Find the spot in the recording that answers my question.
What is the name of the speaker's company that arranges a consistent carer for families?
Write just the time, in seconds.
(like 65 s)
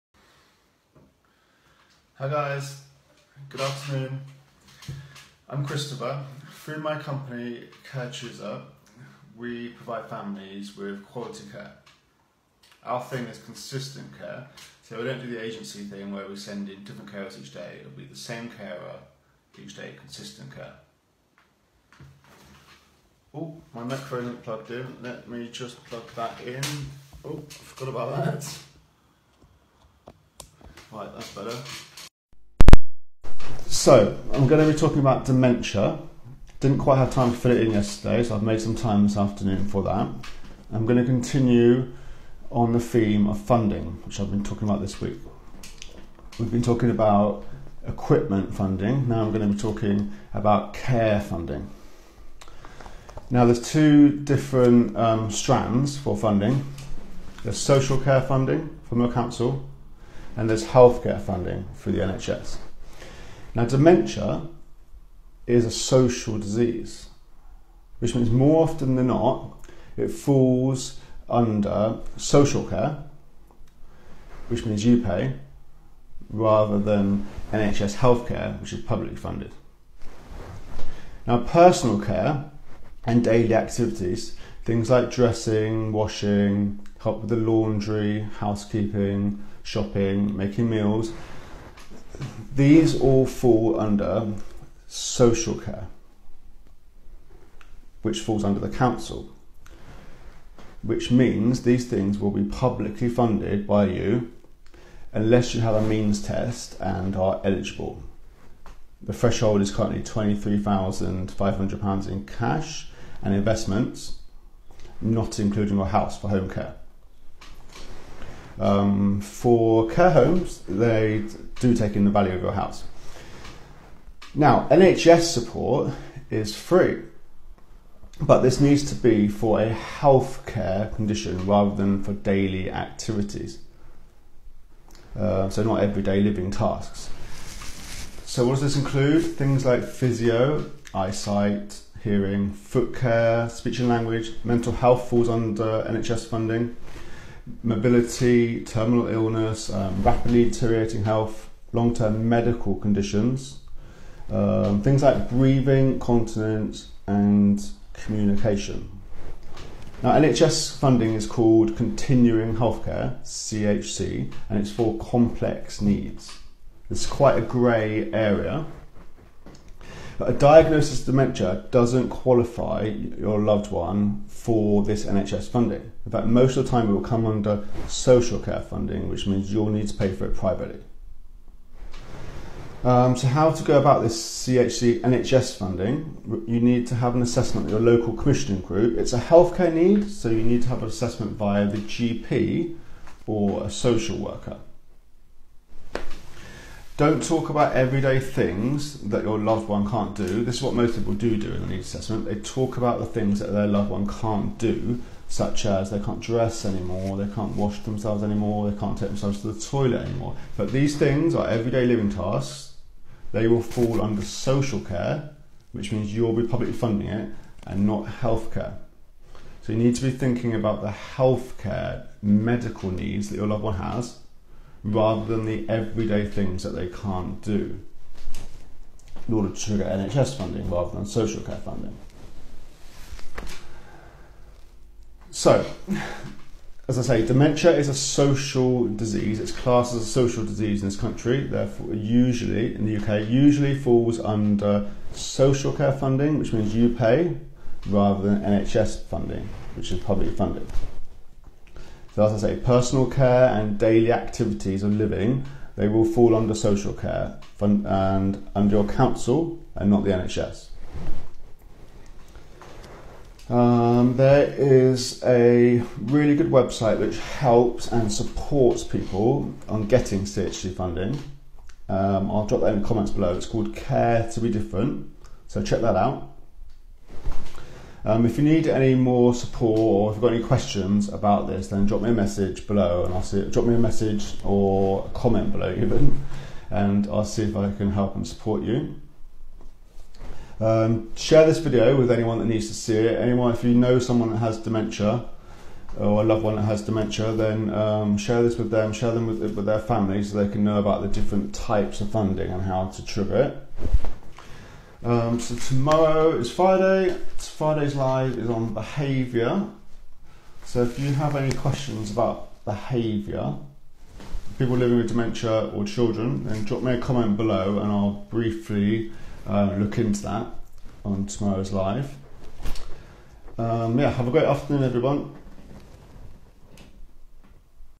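7 s.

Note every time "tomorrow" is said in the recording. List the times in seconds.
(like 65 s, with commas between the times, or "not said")
305 s, 321 s.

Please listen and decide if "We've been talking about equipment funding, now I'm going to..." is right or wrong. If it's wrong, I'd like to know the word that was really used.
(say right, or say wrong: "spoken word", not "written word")
right.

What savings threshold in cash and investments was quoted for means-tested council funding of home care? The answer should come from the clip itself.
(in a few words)
£23,500.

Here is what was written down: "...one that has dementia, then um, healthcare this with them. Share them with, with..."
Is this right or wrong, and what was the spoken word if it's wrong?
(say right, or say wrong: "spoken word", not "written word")
wrong: "share", not "healthcare".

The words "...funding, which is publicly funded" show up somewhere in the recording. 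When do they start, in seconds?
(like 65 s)
249 s.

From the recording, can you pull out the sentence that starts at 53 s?
Now, there's two different um, strands for funding there's social care funding from the council, and there's healthcare funding through the NHS.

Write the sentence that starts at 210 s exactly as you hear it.
But these things are everyday living tasks.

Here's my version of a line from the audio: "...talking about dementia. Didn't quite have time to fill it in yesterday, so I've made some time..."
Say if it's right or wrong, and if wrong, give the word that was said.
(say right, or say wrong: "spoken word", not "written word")
right.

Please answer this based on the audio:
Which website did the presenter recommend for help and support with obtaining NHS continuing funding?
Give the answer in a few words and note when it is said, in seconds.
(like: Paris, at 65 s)
Care to Be Different, at 273 s.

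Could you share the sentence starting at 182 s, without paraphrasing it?
Um, so, how to go about this CHC NHS funding?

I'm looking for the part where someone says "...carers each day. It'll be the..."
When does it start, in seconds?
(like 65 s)
17 s.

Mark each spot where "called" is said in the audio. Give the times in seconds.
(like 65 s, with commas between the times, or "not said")
161 s, 273 s.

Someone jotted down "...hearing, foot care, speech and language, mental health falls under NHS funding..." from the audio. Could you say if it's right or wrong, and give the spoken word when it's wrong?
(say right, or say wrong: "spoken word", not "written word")
right.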